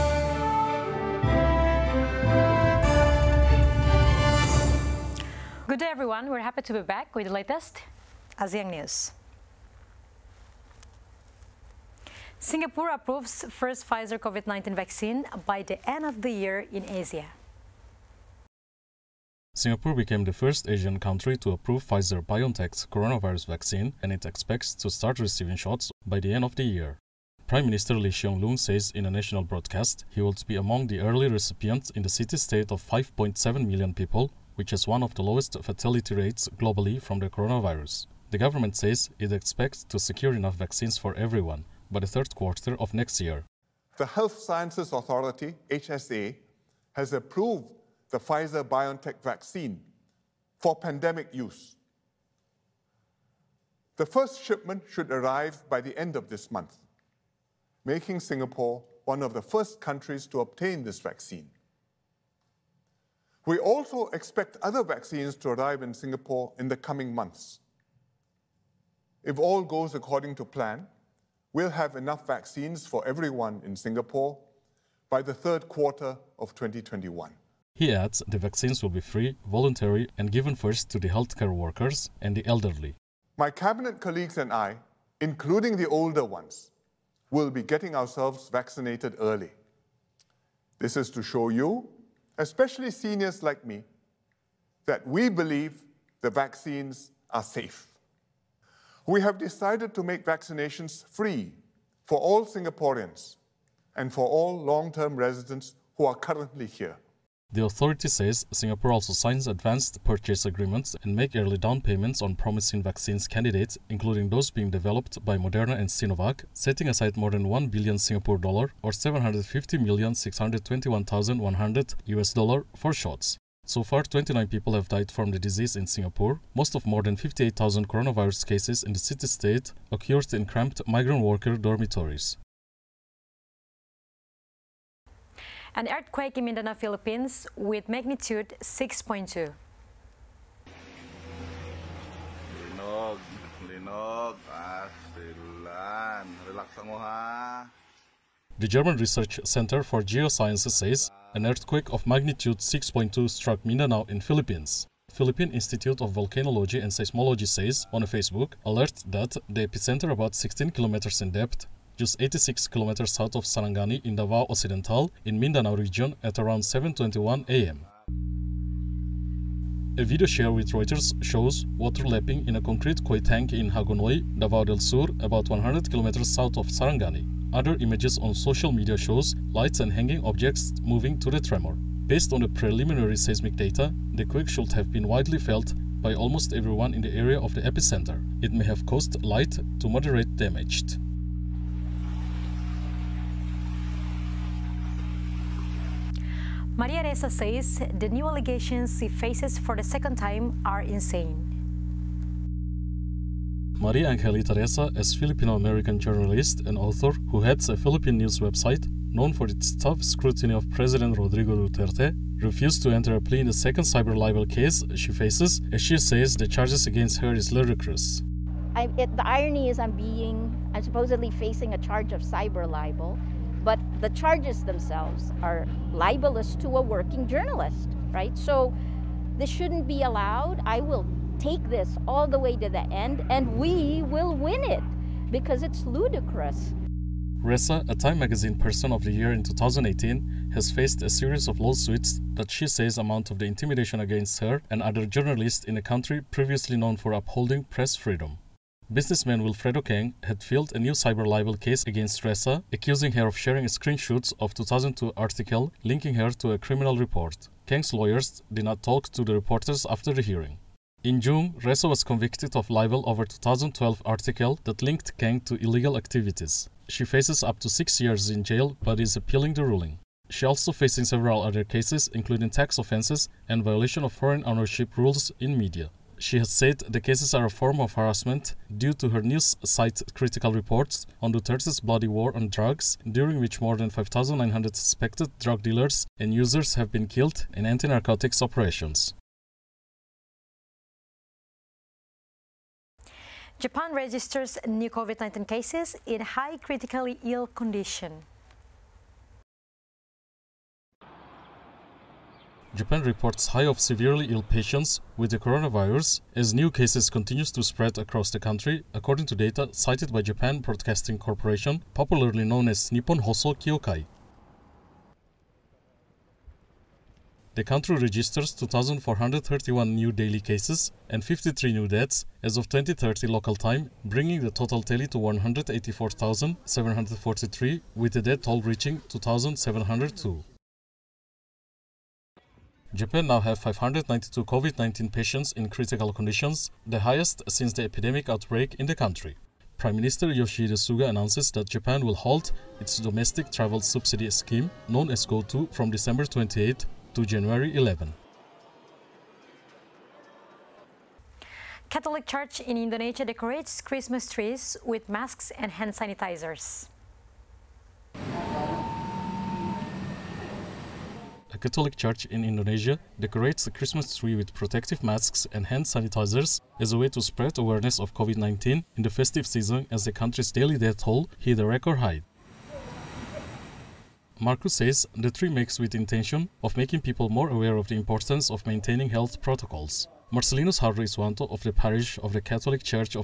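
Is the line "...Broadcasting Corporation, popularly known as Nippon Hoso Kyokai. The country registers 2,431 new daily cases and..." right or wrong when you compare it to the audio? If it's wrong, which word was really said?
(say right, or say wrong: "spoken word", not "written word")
right.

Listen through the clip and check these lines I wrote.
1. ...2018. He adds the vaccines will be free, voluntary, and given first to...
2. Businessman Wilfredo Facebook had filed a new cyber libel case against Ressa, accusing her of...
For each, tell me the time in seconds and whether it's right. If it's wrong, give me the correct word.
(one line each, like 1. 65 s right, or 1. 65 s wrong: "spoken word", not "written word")
1. 76 s wrong: "2021", not "2018"
2. 248 s wrong: "Keng", not "Facebook".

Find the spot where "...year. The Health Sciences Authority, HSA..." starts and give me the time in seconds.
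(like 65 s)
43 s.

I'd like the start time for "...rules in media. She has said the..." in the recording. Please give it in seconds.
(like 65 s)
274 s.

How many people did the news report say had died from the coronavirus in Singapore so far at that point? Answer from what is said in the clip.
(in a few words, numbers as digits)
29.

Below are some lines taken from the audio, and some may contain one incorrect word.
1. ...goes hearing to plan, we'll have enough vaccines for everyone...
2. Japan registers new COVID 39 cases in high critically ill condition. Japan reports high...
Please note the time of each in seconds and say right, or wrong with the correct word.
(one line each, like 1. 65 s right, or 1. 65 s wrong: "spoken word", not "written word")
1. 69 s wrong: "according", not "hearing"
2. 293 s wrong: "19", not "39".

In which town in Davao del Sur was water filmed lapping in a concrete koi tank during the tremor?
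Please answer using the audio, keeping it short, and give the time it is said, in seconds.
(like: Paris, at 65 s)
Hagonoy, at 173 s.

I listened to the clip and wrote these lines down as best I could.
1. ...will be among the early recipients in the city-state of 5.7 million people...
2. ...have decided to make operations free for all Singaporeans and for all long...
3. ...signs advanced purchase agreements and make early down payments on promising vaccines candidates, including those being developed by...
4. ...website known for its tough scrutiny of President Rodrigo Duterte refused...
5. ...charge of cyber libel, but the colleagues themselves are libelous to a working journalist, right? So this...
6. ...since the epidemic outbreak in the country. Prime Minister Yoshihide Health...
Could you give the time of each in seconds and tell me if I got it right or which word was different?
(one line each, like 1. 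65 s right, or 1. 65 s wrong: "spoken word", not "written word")
1. 30 s right
2. 99 s wrong: "vaccinations", not "operations"
3. 109 s right
4. 208 s right
5. 221 s wrong: "charges", not "colleagues"
6. 337 s wrong: "Suga", not "Health".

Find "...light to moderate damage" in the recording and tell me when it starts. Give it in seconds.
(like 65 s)
189 s.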